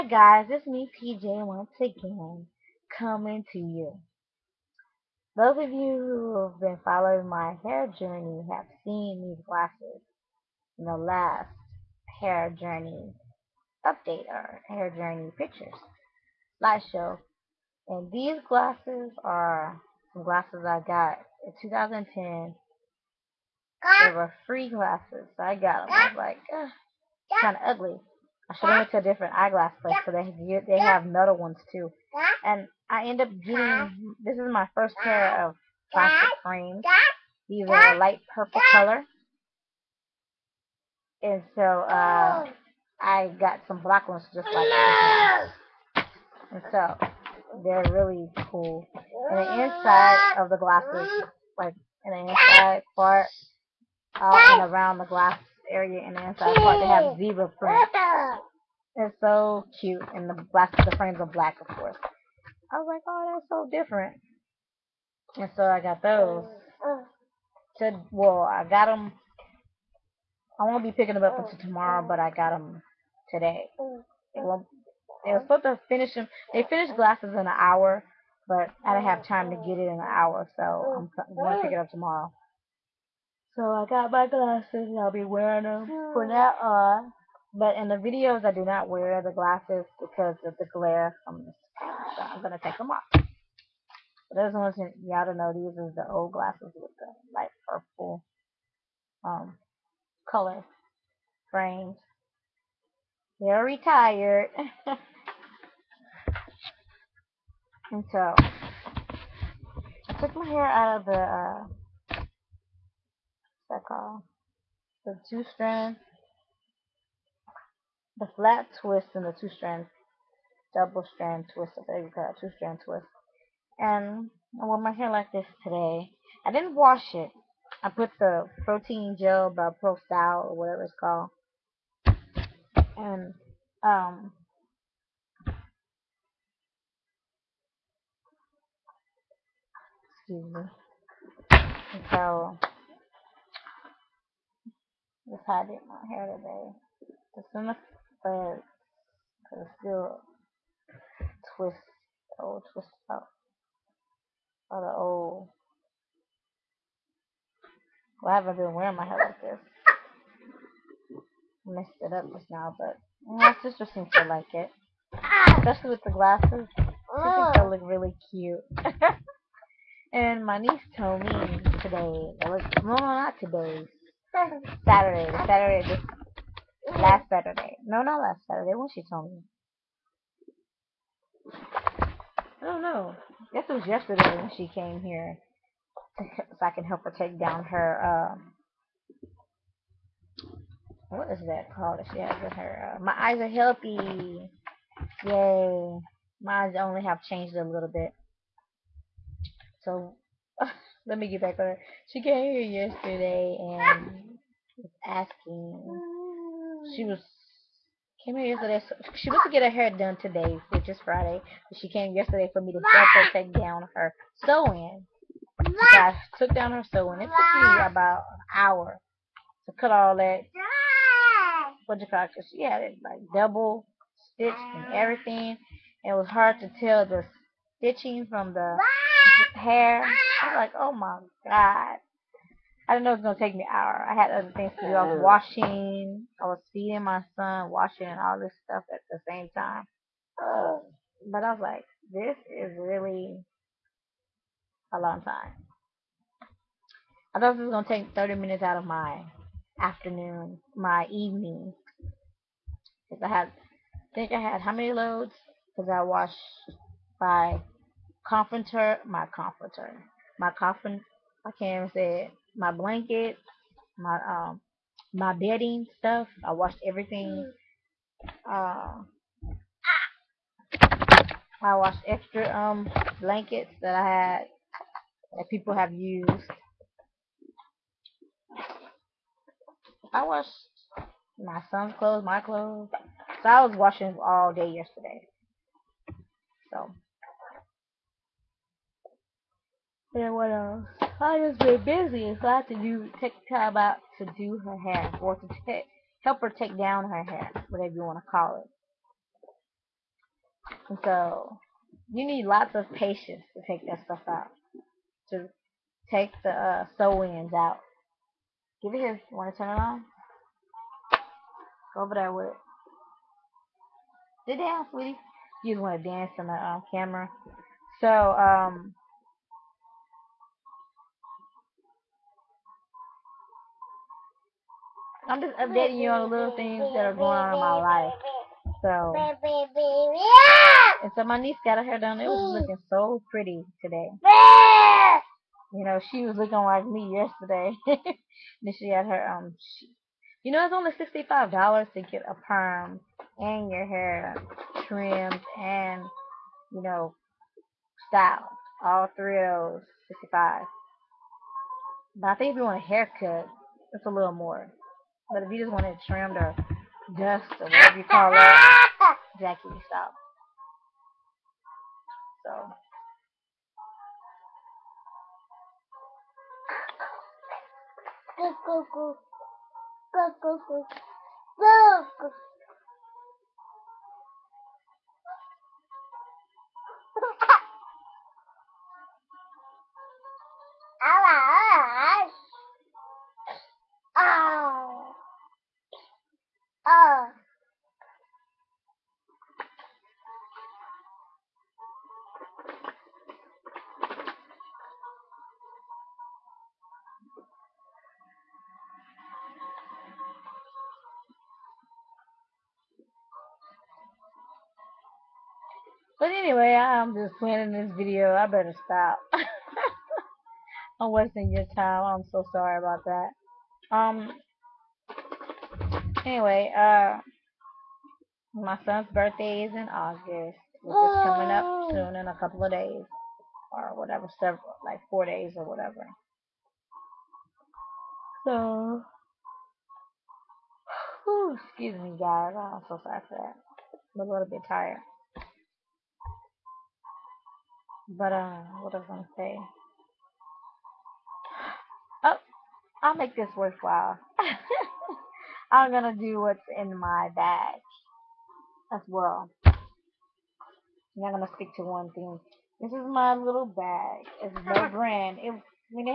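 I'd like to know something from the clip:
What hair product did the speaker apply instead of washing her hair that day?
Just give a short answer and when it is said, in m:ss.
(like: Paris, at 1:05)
protein gel, at 2:08.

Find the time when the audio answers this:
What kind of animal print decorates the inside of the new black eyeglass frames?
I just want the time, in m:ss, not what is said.
0:57.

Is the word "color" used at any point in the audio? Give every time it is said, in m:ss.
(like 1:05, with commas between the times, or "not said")
0:38, 1:40.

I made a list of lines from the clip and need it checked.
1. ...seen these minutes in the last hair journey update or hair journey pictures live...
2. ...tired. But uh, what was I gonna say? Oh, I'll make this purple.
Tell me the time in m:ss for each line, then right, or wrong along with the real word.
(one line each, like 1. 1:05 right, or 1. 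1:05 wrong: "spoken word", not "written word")
1. 0:08 wrong: "glasses", not "minutes"
2. 7:14 wrong: "worthwhile", not "purple".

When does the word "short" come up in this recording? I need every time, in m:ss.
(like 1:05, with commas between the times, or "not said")
not said.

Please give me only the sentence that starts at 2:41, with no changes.
Messed it up just now, but my sister seems to like it.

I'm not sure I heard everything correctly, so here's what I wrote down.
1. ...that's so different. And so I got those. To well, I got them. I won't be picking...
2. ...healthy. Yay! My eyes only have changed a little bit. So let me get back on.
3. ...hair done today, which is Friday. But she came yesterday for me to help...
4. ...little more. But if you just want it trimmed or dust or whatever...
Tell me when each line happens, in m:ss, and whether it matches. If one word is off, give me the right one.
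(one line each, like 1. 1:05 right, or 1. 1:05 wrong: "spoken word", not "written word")
1. 1:03 right
2. 3:13 right
3. 3:29 right
4. 5:54 right.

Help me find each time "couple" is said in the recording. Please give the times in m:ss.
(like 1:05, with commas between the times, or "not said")
7:02.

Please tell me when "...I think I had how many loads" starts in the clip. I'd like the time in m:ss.
4:13.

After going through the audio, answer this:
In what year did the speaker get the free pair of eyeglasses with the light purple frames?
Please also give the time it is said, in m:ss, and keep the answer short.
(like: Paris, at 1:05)
2010, at 0:21.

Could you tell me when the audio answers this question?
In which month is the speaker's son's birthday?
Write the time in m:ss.
6:59.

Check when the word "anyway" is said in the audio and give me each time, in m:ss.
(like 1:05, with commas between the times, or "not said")
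6:46, 6:56.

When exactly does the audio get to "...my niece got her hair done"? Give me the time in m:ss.
5:31.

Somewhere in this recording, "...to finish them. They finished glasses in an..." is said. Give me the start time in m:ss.
1:15.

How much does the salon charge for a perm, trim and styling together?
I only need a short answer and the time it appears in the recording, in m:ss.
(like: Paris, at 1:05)
$65, at 5:40.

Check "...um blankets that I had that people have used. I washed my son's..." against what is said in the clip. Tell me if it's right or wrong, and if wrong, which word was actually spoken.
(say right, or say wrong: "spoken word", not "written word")
right.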